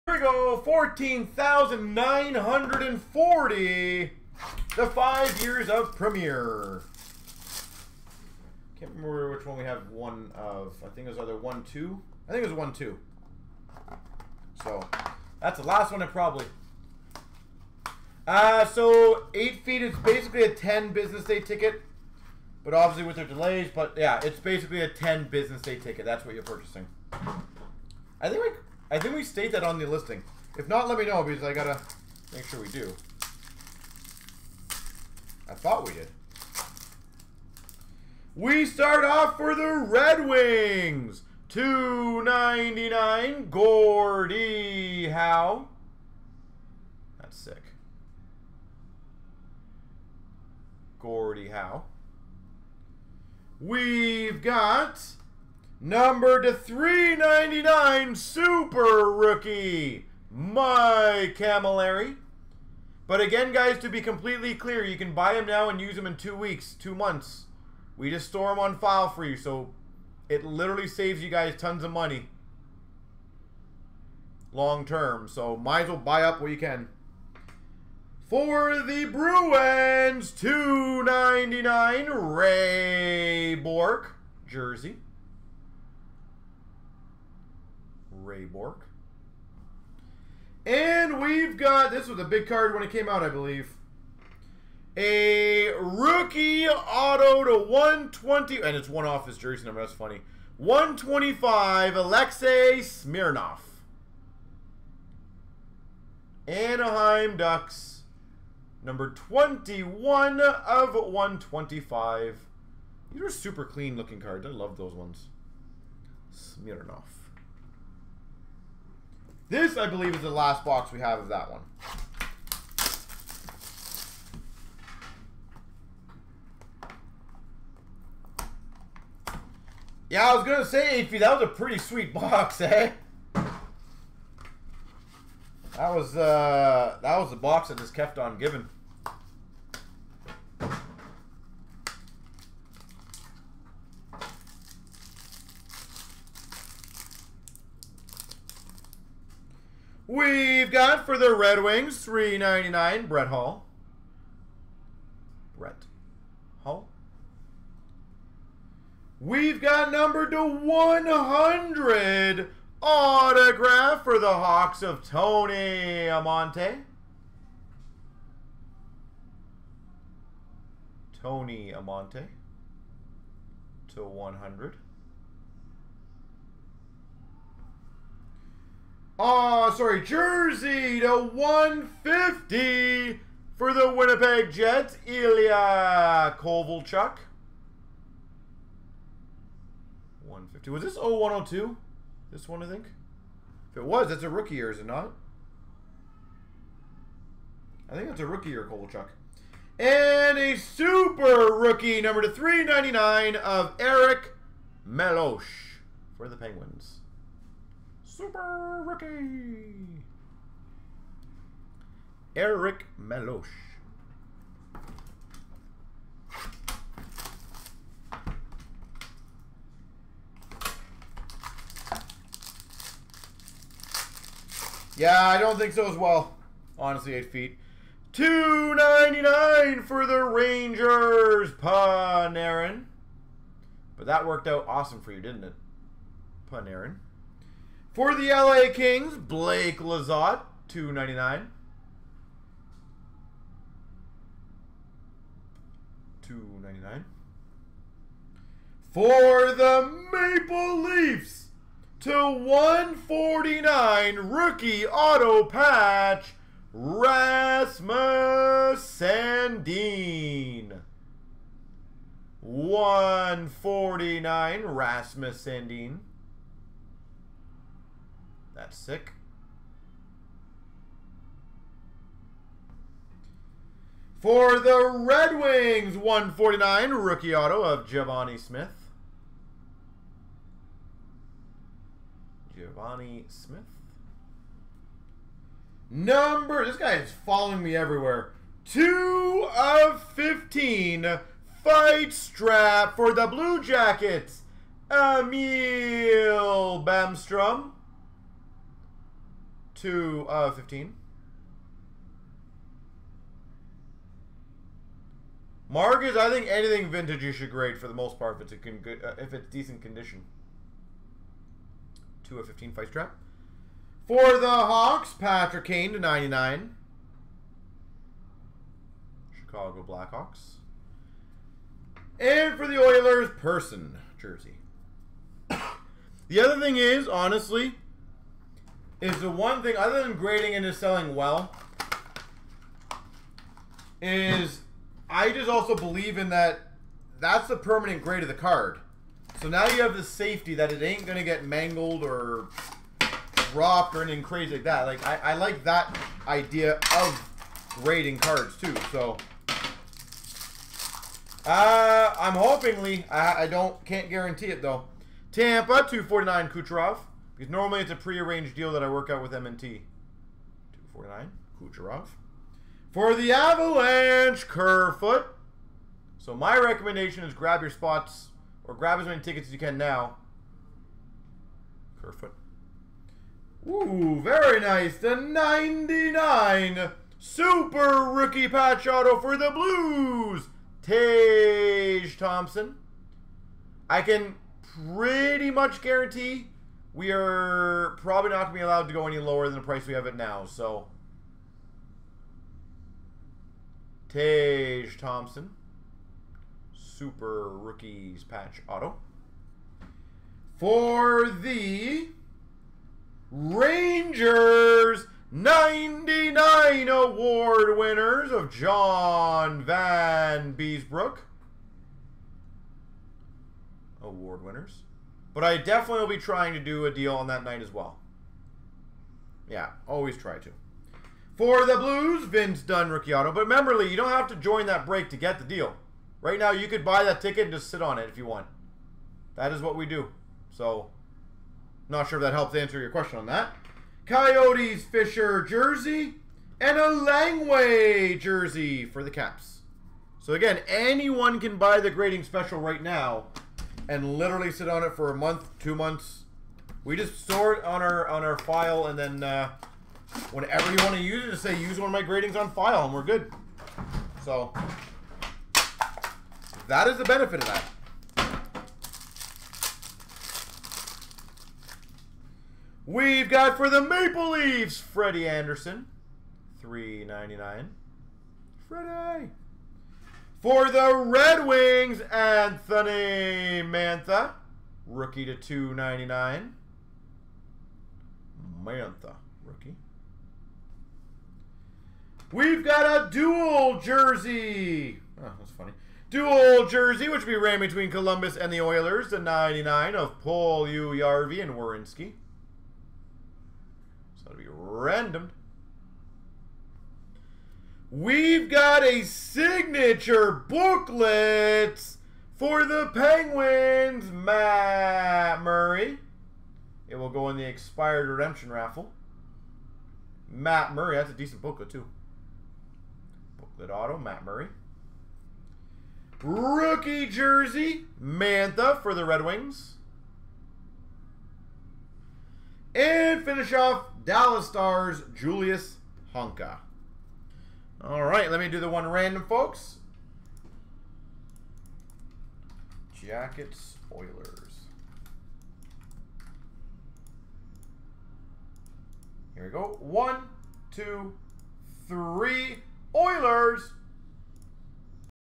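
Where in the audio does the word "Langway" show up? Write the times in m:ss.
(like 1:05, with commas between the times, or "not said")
7:16.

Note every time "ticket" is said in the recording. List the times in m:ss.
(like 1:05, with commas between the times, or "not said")
0:21, 0:25, 6:09, 7:07.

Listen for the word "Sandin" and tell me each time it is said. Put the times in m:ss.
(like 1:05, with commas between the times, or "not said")
4:18, 4:25.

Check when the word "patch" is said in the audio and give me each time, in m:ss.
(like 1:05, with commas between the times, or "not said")
4:15, 6:18, 6:38.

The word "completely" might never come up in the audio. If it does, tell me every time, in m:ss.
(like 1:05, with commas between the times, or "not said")
1:03.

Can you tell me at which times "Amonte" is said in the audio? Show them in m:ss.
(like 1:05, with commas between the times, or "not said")
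2:46, 2:51.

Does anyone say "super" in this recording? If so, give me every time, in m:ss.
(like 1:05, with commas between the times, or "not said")
0:58, 1:53, 3:20, 3:28, 6:17, 6:36.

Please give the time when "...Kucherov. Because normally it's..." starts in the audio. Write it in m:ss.
5:56.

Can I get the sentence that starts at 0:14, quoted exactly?
So that's the last one, probably.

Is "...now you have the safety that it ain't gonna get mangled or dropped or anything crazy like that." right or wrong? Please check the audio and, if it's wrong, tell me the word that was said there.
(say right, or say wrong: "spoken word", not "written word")
right.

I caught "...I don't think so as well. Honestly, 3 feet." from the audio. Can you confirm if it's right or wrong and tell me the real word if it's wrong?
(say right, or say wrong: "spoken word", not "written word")
wrong: "8", not "3".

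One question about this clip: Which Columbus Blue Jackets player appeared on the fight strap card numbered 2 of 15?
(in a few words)
Emil Bemstrom.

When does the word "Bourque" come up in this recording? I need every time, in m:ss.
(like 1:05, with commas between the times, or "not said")
1:23, 1:28.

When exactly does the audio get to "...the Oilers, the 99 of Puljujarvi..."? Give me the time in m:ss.
8:08.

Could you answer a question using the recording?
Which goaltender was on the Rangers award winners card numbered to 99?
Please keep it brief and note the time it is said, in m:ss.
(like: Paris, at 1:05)
John Vanbiesbrouck, at 6:48.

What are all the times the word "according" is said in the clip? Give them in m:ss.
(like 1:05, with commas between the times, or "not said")
not said.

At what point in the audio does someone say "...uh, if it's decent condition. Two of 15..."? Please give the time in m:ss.
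5:08.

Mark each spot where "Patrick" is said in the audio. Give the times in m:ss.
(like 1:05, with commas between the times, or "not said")
5:15.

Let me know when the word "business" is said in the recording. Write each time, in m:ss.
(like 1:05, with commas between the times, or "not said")
0:20, 0:25.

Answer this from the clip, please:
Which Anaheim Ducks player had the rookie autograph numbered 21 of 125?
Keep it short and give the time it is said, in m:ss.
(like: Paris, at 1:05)
Alexei Smirnov, at 1:41.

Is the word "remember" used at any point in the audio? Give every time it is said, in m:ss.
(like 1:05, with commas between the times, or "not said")
0:08, 7:03.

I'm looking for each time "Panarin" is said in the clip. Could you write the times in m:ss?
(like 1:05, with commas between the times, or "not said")
3:51, 3:56.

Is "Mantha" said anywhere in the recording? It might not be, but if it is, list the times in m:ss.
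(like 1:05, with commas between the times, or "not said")
7:53, 7:58, 8:38.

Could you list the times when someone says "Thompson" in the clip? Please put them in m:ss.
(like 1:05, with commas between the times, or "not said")
6:22, 6:34.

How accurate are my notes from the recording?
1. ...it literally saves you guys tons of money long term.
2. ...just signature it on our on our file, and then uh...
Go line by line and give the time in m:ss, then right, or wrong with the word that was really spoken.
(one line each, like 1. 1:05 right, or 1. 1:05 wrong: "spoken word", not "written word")
1. 1:10 right
2. 7:26 wrong: "store", not "signature".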